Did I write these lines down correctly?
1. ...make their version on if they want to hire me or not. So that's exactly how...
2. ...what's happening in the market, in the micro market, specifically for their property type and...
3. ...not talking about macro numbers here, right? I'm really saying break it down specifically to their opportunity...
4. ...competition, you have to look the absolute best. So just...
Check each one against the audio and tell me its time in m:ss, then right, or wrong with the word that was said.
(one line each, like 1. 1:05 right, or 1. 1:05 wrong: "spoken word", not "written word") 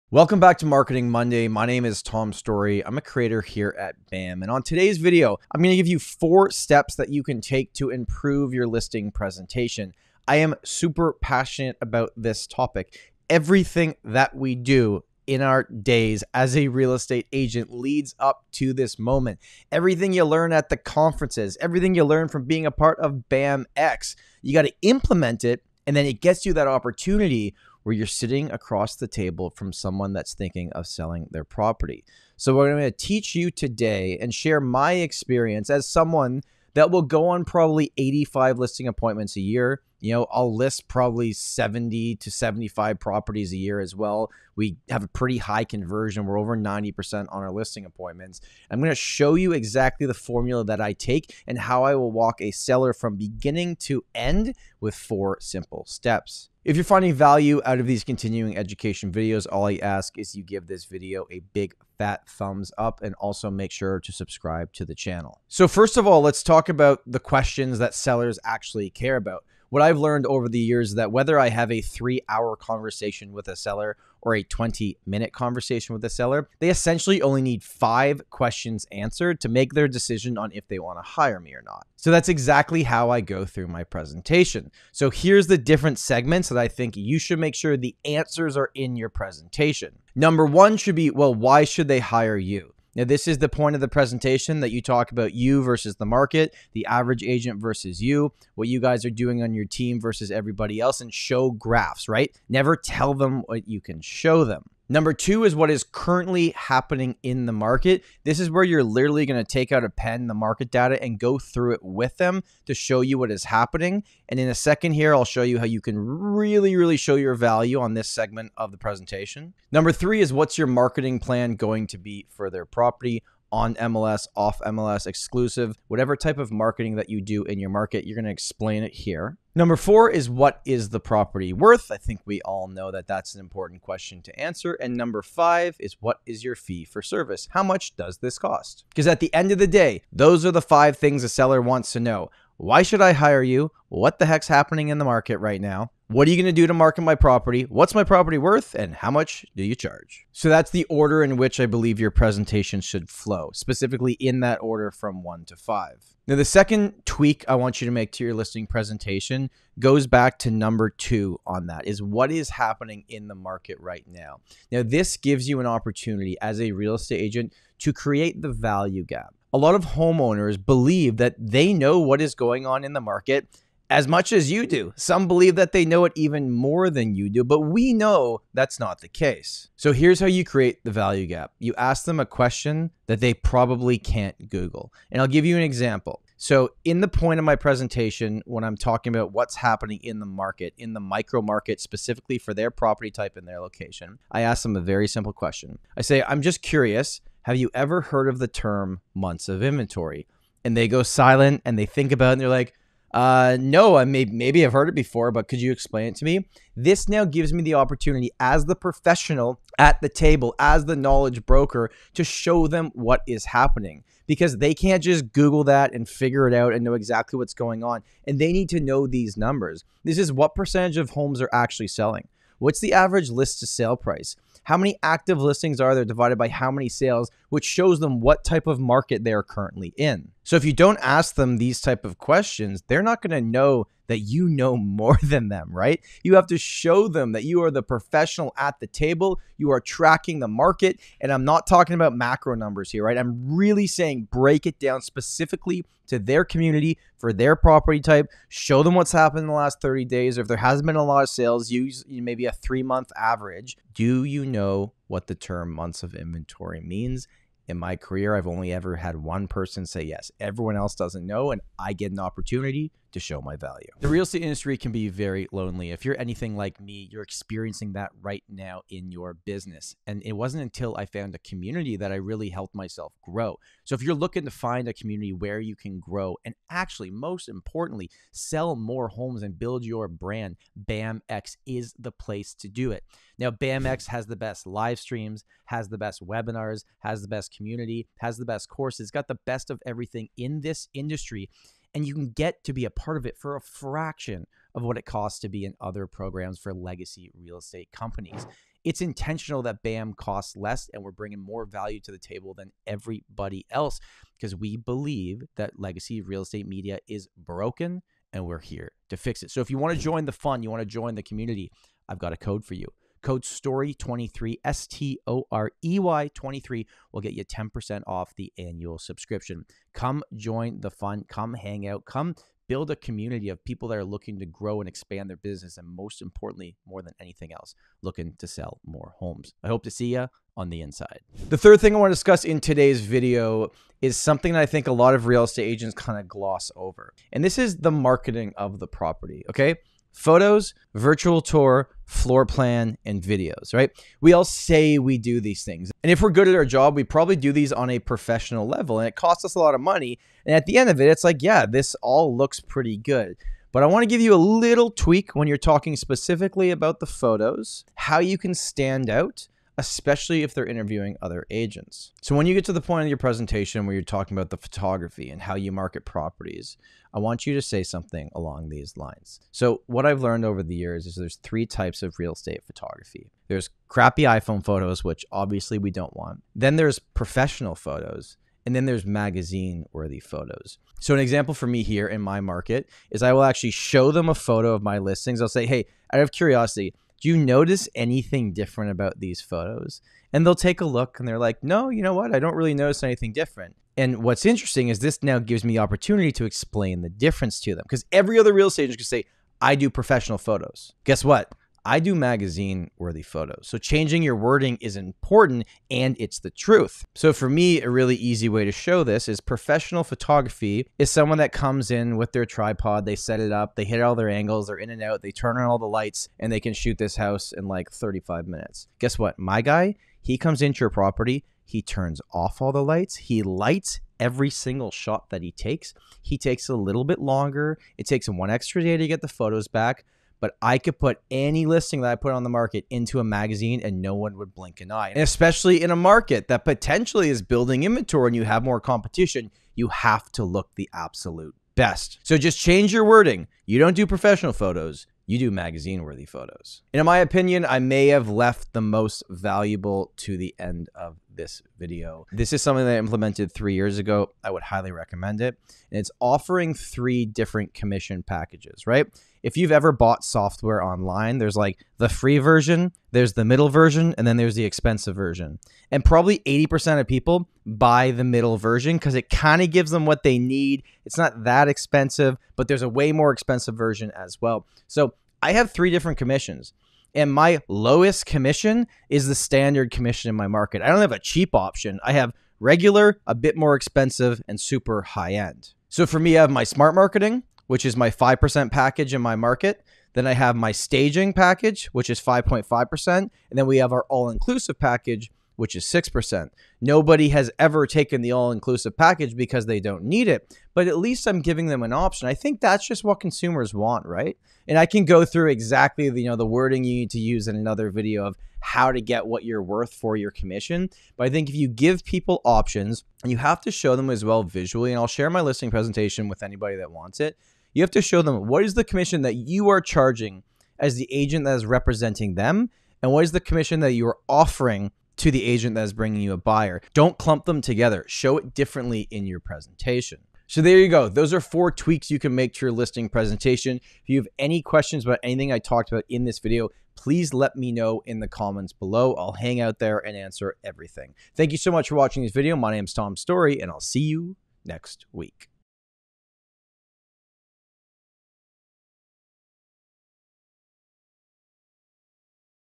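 1. 1:19 wrong: "decision", not "version"
2. 3:09 right
3. 4:01 wrong: "community", not "opportunity"
4. 7:18 right.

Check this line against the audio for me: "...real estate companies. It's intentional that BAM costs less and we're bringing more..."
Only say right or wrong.
right.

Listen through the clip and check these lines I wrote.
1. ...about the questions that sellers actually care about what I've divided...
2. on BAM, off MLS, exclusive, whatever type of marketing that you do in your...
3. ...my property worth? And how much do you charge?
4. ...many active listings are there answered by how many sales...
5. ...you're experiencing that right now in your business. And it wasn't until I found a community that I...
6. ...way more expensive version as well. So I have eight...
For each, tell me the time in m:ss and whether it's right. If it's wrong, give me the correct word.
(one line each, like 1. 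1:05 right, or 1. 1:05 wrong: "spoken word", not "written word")
1. 1:06 wrong: "learned", not "divided"
2. 2:03 wrong: "MLS", not "BAM"
3. 2:27 right
4. 3:44 wrong: "divided", not "answered"
5. 4:27 right
6. 7:52 wrong: "three", not "eight".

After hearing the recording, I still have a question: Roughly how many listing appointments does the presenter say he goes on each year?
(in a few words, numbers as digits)
85.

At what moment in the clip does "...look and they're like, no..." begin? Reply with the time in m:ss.
6:30.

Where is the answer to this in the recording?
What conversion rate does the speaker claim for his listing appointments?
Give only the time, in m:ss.
0:46.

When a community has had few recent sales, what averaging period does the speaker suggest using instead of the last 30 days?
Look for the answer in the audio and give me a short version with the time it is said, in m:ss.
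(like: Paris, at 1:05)
3-month average, at 4:12.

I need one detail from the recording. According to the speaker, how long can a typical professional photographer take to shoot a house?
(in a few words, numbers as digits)
35 minutes.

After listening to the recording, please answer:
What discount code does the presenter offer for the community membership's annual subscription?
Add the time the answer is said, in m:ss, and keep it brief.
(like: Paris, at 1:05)
STOREY23, at 5:13.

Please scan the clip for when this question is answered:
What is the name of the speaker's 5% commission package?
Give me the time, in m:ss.
8:06.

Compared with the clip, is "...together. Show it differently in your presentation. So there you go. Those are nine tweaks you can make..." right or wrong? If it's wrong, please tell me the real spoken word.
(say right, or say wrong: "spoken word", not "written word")
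wrong: "four", not "nine".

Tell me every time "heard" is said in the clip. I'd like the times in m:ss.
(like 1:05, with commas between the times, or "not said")
3:18, 3:24.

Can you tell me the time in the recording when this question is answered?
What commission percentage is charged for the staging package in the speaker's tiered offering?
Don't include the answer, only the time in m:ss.
8:12.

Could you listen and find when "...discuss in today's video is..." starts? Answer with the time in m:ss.
5:32.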